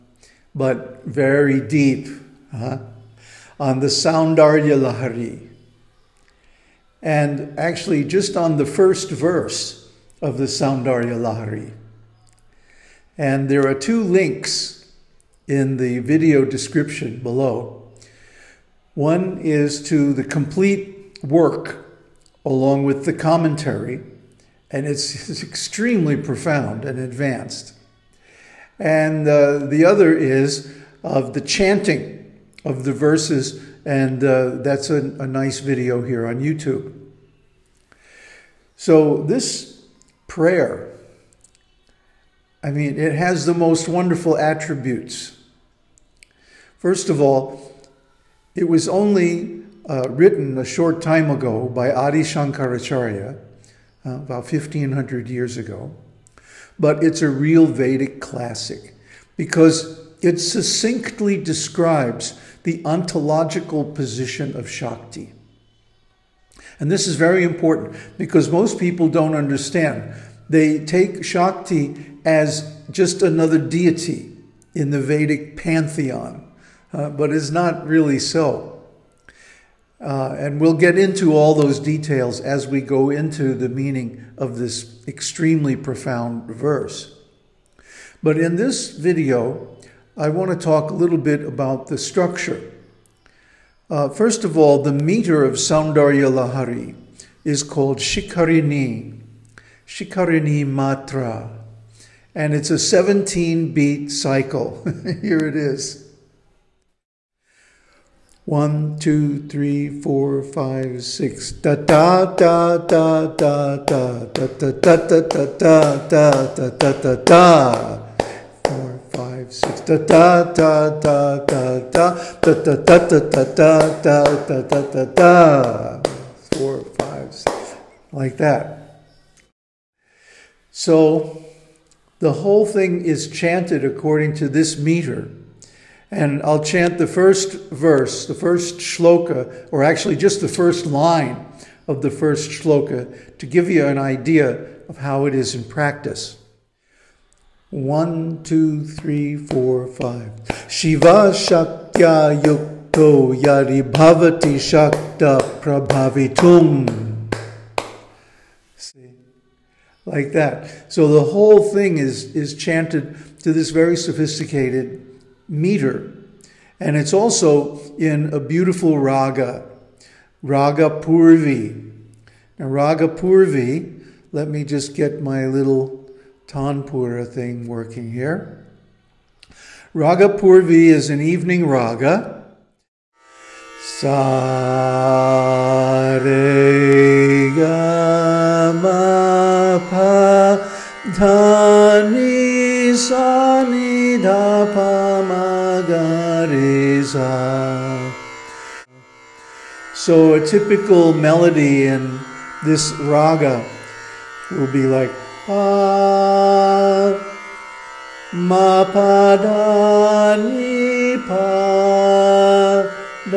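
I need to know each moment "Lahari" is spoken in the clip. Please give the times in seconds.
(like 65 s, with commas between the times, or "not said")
4 s, 11 s, 96 s.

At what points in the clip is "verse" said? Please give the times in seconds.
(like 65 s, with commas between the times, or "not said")
9 s, 32 s, 86 s, 137 s.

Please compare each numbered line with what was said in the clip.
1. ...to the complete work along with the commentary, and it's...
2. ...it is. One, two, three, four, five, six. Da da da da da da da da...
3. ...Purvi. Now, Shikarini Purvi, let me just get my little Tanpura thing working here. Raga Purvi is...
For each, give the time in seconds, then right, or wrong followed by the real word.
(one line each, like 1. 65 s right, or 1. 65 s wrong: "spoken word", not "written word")
1. 19 s right
2. 105 s right
3. 170 s wrong: "Raga", not "Shikarini".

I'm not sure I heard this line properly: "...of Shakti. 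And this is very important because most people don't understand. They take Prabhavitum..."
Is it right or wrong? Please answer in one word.
wrong.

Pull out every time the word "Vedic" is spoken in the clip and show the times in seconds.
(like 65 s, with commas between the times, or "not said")
57 s, 75 s.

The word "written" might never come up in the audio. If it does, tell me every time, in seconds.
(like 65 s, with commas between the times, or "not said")
50 s.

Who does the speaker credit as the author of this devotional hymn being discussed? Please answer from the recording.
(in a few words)
Adi Shankaracharya.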